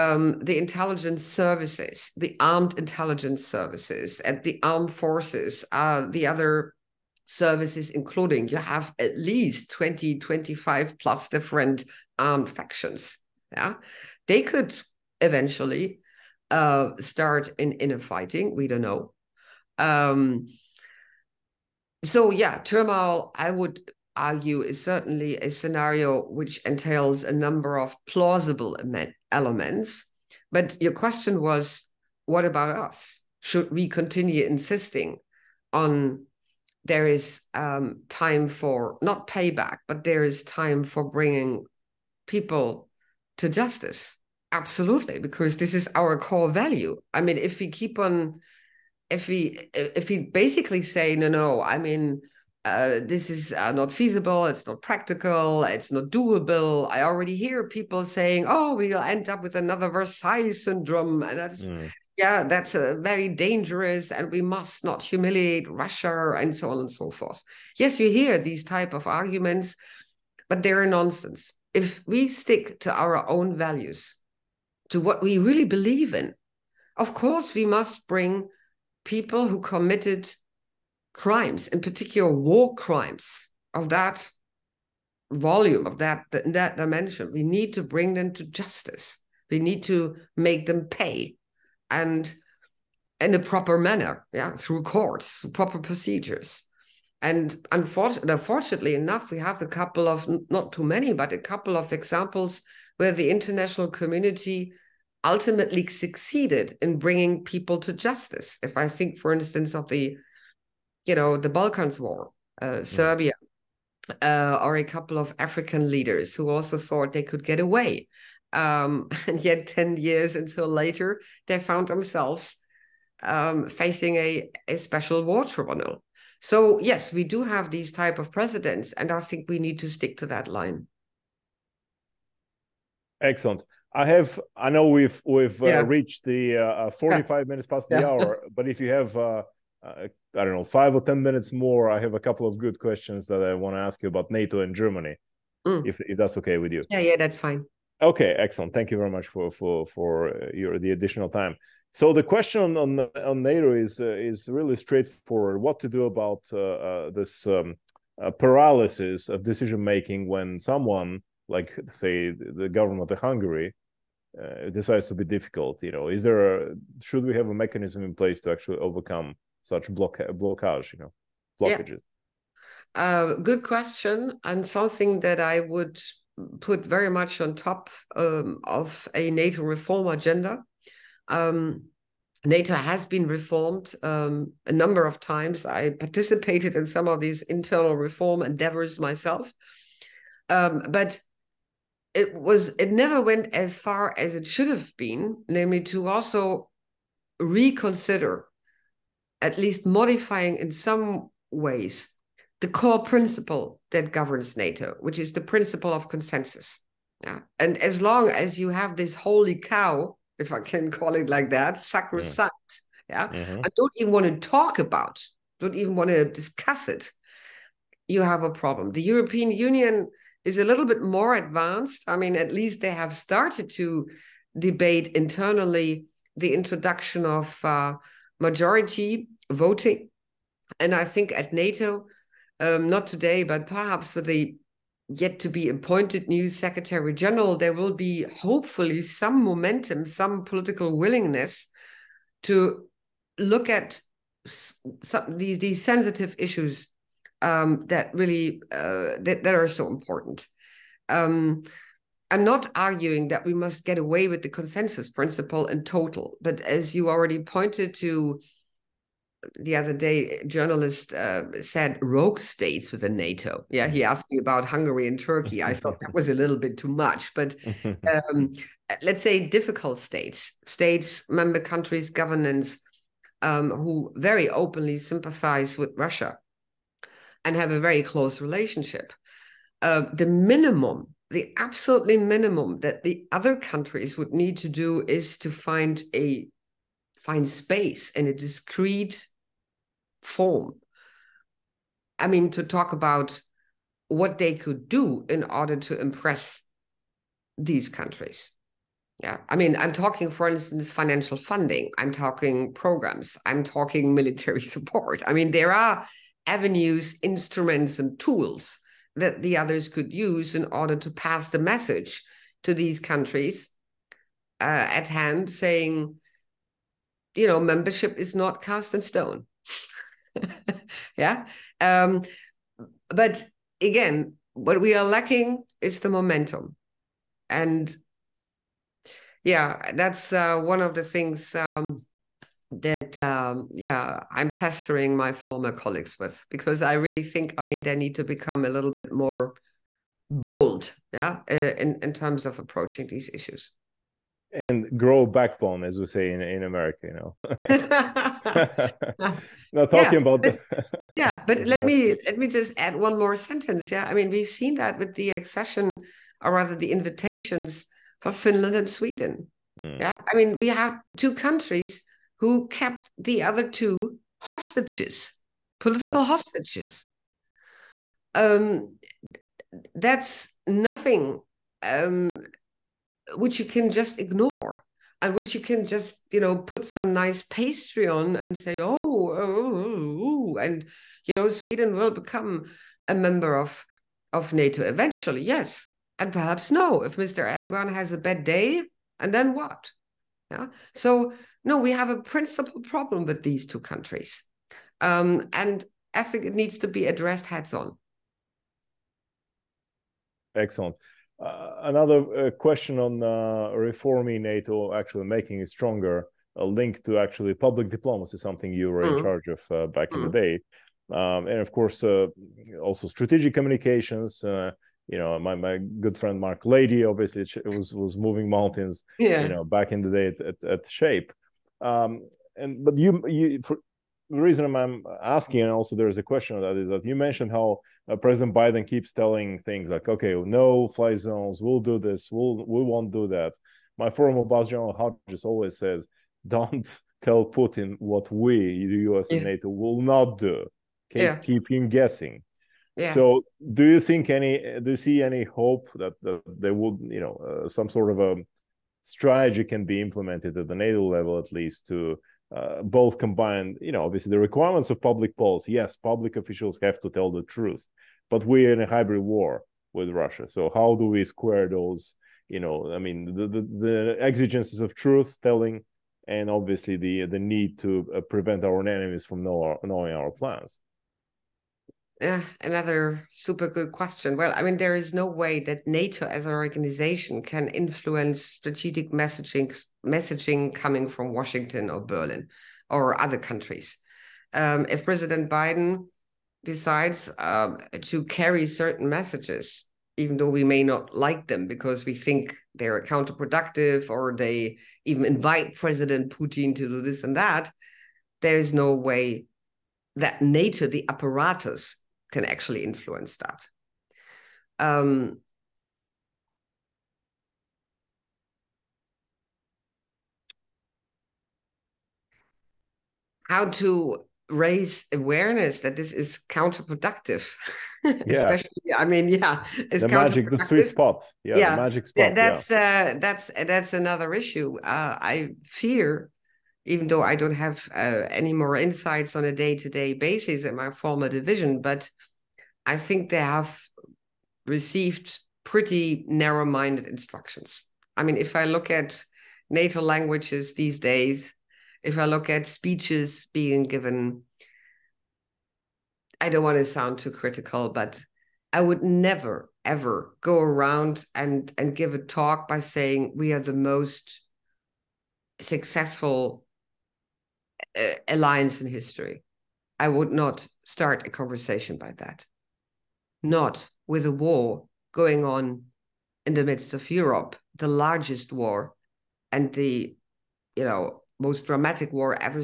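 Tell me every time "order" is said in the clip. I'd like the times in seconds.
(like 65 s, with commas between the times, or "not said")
295 s, 310 s.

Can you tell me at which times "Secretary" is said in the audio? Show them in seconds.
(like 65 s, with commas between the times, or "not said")
236 s.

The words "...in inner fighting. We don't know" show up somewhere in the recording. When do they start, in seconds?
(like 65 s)
17 s.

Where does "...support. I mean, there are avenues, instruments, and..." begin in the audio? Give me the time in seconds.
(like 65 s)
304 s.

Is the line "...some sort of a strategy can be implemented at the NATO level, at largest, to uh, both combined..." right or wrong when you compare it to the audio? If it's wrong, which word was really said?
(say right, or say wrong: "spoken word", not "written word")
wrong: "least", not "largest".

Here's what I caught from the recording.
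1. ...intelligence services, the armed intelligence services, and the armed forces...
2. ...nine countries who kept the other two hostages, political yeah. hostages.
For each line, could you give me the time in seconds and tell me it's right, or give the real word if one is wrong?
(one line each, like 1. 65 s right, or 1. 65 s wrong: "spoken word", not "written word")
1. 0 s right
2. 361 s wrong: "two", not "nine".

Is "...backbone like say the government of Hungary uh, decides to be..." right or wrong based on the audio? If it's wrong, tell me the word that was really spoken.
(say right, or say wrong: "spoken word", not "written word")
wrong: "someone", not "backbone".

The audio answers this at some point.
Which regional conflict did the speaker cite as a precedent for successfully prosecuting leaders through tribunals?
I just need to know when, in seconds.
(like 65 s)
111 s.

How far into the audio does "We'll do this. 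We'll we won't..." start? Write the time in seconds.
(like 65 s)
431 s.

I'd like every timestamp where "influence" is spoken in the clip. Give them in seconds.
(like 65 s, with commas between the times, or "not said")
477 s, 502 s.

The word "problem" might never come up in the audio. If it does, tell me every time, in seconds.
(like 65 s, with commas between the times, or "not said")
218 s, 392 s.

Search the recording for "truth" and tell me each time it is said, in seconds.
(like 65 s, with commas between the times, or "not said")
457 s, 464 s.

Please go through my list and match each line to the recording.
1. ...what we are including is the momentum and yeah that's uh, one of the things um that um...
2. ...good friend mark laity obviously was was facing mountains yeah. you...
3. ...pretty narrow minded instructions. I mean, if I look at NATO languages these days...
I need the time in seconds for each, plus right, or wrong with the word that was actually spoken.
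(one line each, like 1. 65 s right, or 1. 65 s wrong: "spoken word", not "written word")
1. 324 s wrong: "lacking", not "including"
2. 415 s wrong: "moving", not "facing"
3. 535 s right.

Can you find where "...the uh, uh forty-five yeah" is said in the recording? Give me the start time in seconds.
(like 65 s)
136 s.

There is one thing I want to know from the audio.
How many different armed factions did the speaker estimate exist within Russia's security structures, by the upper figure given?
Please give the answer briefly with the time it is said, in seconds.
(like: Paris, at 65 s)
25, at 10 s.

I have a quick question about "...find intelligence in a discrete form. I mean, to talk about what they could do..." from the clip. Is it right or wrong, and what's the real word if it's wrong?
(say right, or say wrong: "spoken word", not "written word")
wrong: "space", not "intelligence".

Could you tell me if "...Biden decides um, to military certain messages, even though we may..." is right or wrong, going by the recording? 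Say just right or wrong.
wrong.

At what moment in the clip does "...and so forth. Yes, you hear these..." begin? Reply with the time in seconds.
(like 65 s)
66 s.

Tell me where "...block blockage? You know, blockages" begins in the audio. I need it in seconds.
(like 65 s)
169 s.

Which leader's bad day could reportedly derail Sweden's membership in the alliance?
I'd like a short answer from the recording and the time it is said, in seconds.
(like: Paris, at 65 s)
Erdogan, at 387 s.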